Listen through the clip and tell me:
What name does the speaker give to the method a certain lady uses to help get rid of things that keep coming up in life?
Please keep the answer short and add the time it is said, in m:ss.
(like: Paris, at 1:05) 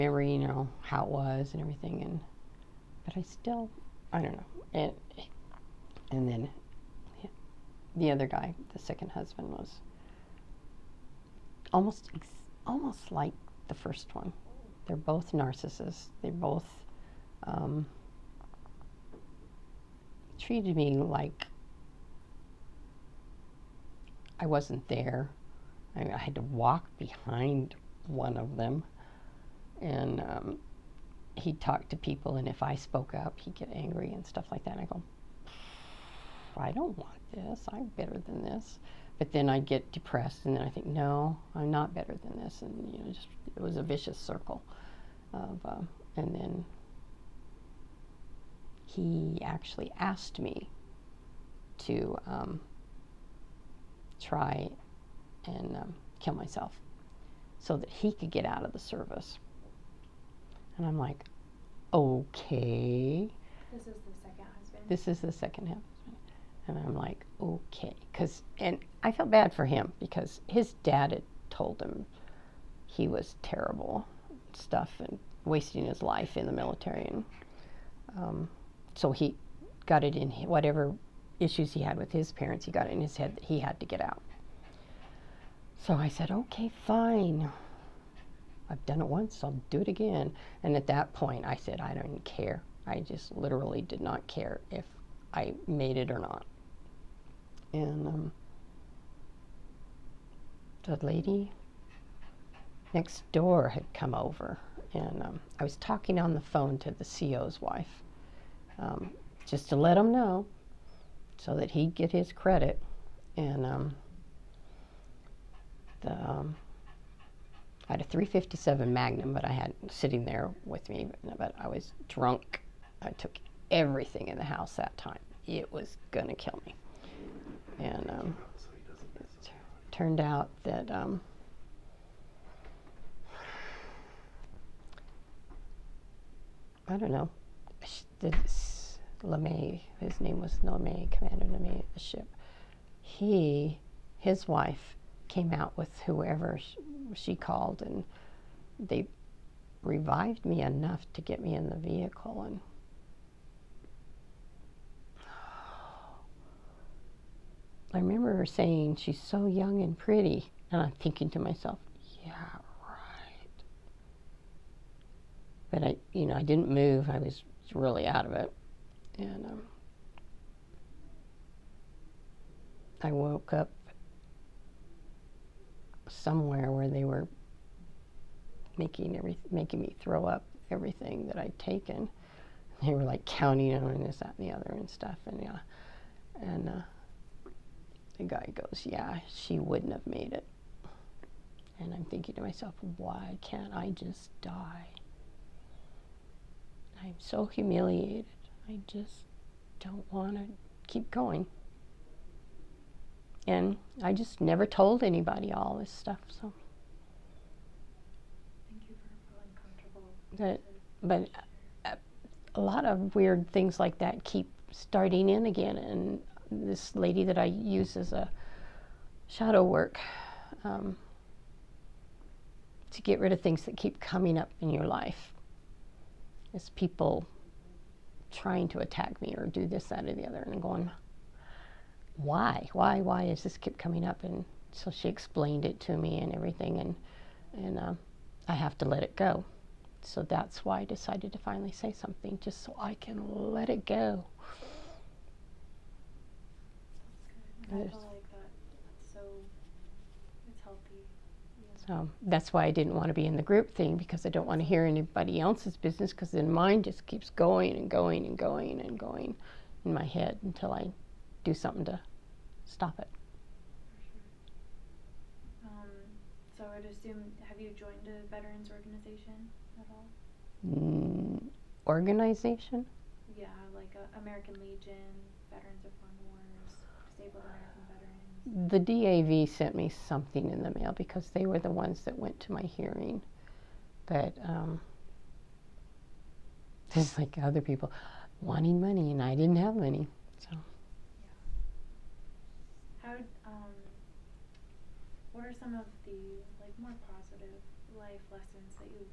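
Shadow work, at 3:39.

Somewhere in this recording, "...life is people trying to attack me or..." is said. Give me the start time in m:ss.
3:44.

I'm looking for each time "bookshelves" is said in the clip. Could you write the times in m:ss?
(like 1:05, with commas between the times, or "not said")
not said.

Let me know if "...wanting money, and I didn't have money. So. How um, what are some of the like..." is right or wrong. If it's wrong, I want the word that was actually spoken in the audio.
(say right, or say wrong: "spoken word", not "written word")
right.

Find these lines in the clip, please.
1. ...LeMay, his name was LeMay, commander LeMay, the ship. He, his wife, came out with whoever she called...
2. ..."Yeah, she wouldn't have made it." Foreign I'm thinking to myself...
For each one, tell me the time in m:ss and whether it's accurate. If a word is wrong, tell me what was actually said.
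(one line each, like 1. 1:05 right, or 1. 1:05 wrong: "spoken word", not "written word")
1. 2:19 right
2. 3:08 wrong: "And", not "Foreign".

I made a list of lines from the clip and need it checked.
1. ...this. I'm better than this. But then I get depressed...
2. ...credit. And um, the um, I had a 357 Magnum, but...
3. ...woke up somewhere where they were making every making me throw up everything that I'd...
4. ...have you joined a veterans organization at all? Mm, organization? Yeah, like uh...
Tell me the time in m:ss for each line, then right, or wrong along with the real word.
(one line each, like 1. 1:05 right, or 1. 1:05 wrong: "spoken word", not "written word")
1. 0:37 right
2. 1:52 right
3. 2:53 right
4. 4:27 right.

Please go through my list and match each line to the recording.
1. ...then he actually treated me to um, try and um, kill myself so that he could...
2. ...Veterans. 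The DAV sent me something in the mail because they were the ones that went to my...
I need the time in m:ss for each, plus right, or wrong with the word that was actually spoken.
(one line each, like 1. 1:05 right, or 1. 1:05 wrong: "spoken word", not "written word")
1. 0:46 wrong: "asked", not "treated"
2. 4:38 right.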